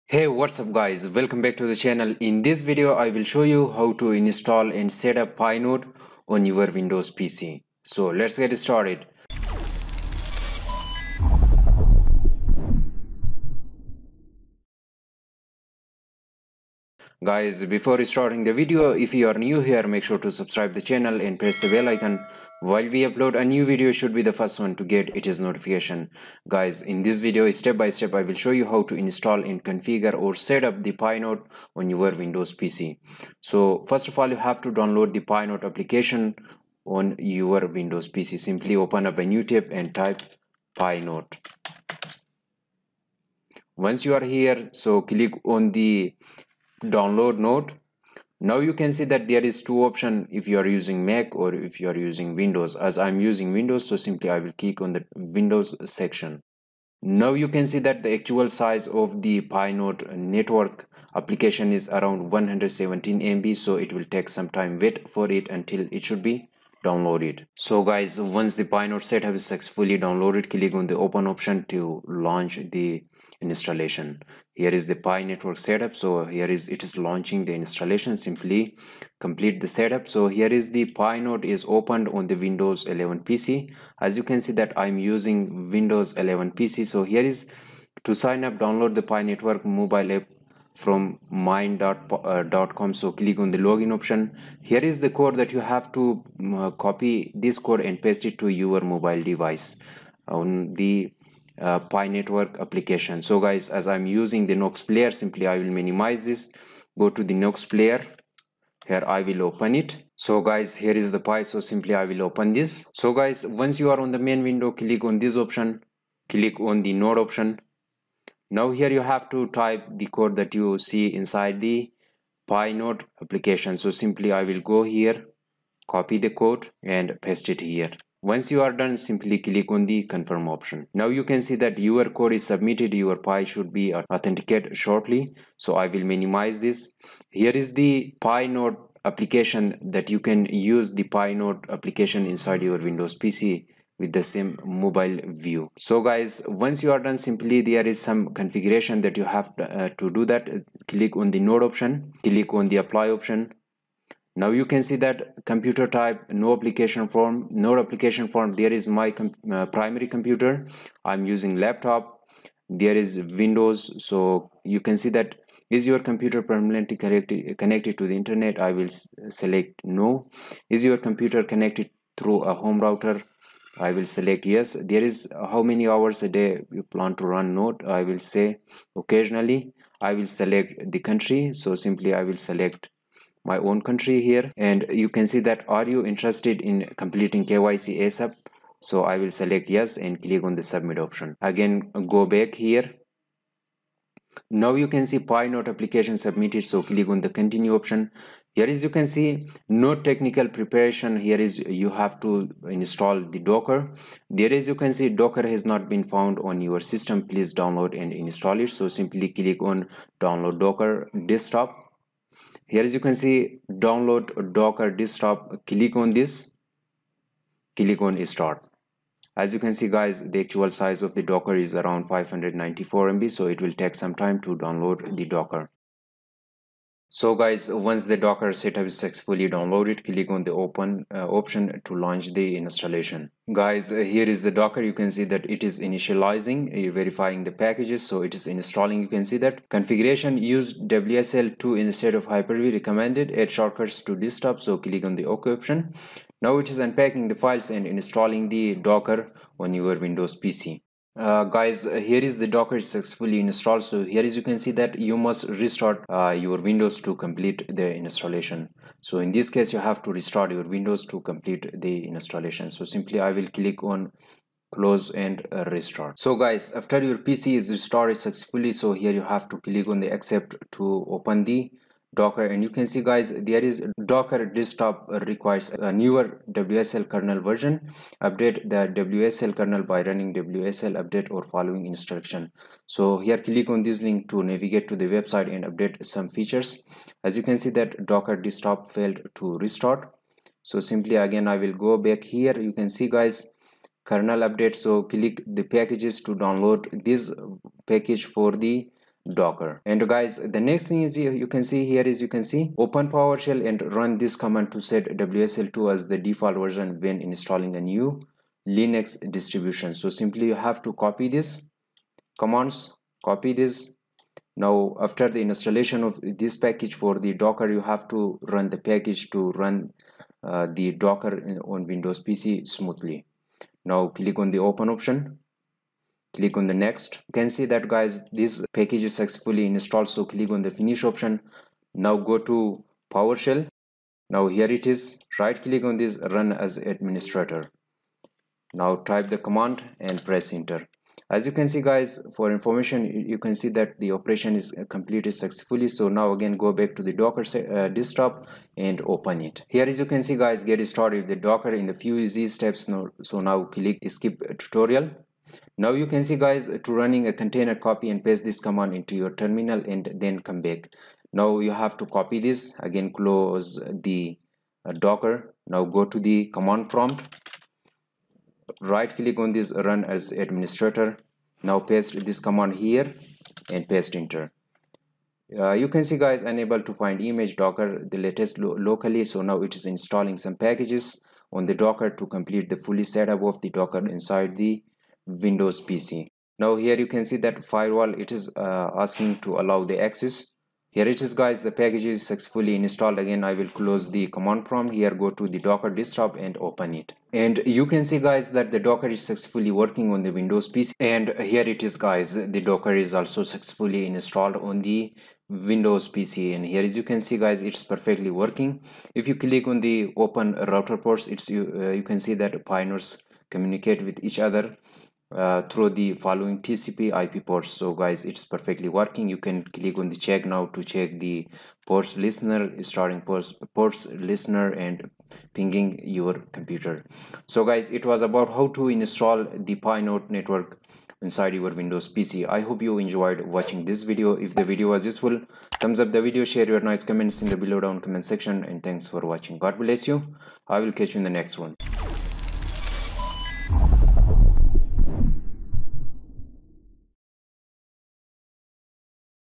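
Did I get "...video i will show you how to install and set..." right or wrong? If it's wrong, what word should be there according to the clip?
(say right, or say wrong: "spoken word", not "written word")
right.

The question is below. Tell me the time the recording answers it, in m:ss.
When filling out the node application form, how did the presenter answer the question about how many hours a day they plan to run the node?
2:58.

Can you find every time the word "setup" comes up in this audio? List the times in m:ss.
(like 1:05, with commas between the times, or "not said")
1:09, 1:15, 1:19, 3:48, 6:23.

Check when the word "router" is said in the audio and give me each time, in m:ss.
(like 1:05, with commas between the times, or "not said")
2:52, 6:50.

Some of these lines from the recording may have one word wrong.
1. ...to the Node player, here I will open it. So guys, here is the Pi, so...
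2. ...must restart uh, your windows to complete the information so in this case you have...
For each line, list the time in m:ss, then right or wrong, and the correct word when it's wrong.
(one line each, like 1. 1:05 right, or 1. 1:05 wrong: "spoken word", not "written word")
1. 1:47 wrong: "Nox", not "Node"
2. 4:15 wrong: "installation", not "information".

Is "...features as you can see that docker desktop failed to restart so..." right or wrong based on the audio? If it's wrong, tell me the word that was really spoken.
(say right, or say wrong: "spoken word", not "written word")
right.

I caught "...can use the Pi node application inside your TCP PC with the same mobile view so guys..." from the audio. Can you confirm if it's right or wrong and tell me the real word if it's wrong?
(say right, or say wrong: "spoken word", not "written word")
wrong: "Windows", not "TCP".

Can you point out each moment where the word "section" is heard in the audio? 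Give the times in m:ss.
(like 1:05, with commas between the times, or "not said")
0:55, 7:18.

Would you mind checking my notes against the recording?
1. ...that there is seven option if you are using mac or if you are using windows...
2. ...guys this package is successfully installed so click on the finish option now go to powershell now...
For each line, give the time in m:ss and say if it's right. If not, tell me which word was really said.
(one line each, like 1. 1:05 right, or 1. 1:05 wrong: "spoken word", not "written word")
1. 0:49 wrong: "two", not "seven"
2. 5:27 right.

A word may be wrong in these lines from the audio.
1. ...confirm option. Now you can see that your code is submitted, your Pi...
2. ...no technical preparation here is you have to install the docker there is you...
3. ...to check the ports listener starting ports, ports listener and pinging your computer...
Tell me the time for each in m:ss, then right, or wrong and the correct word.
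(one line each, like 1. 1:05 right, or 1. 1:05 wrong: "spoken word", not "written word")
1. 2:10 right
2. 3:19 right
3. 7:00 right.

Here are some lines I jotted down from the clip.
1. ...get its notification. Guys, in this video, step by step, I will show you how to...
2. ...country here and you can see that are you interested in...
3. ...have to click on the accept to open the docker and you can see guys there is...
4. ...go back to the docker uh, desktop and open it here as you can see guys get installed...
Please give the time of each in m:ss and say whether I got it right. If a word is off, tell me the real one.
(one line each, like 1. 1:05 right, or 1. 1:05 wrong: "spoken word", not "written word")
1. 0:24 right
2. 3:03 right
3. 4:29 right
4. 5:46 wrong: "started", not "installed".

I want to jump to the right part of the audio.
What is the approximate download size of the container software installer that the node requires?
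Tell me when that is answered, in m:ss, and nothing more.
3:42.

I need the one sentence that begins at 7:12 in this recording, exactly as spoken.
I hope you enjoyed watching this video.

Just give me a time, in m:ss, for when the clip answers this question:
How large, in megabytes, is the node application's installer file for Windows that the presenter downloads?
1:02.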